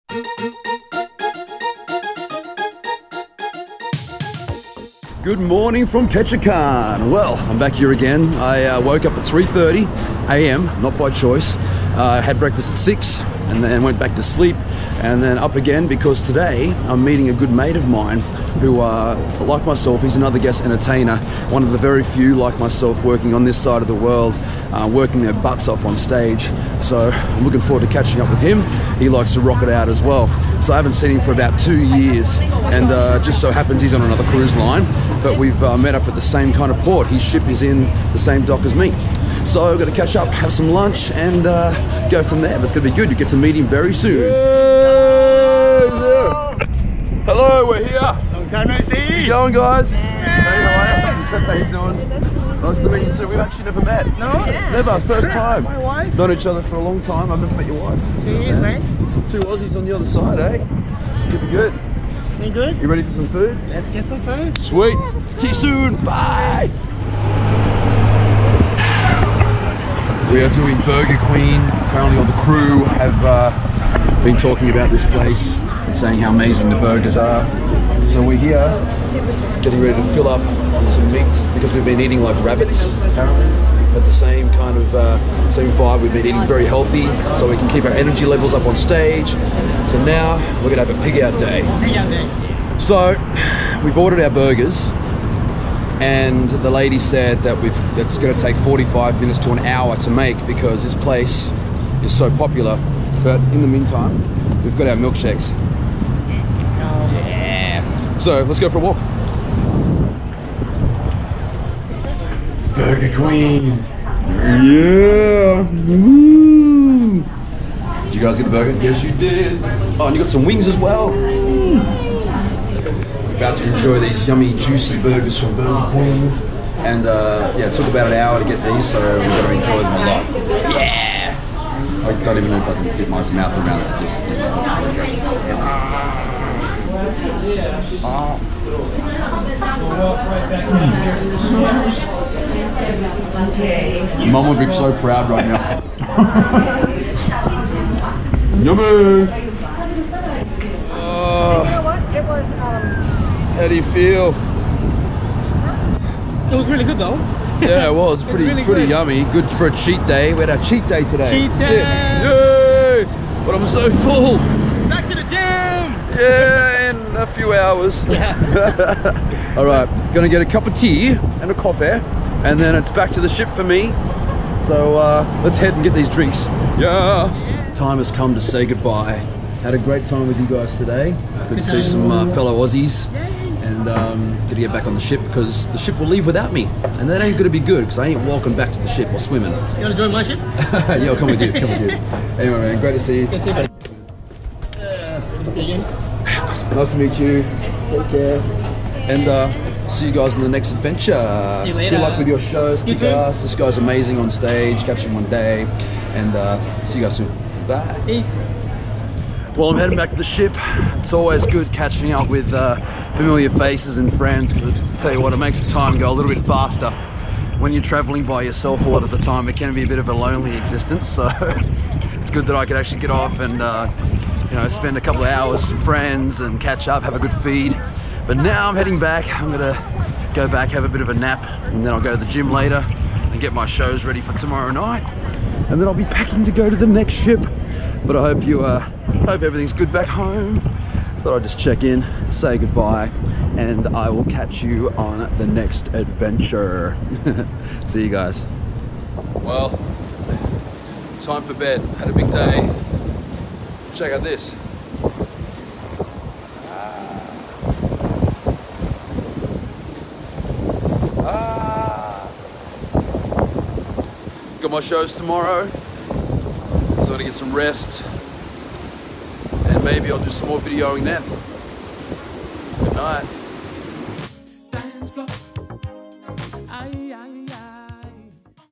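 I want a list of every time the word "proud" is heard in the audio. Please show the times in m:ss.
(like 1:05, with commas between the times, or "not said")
2:25.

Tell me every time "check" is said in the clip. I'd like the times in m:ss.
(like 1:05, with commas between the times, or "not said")
4:01, 4:13.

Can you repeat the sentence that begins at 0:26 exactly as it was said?
So I'm looking forward to catching up with him.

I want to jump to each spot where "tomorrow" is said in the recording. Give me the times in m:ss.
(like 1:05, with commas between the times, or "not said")
3:54, 4:25.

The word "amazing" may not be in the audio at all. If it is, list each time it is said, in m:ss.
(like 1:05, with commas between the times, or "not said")
1:16, 3:23.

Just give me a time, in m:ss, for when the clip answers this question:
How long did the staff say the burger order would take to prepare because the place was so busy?
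1:38.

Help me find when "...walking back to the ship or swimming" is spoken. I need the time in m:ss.
3:08.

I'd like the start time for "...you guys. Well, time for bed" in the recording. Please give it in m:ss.
4:08.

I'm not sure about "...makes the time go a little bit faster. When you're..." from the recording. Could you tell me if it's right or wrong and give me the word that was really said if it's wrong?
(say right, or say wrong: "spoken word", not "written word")
right.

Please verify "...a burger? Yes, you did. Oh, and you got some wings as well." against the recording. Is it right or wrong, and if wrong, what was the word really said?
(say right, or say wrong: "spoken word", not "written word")
right.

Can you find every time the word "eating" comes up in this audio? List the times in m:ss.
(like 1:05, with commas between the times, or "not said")
1:21, 1:26.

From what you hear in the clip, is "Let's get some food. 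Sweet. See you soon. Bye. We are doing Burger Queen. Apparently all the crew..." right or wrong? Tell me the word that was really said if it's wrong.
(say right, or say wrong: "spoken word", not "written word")
right.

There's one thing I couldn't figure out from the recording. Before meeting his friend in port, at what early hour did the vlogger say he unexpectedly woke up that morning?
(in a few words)
3:30 a.m.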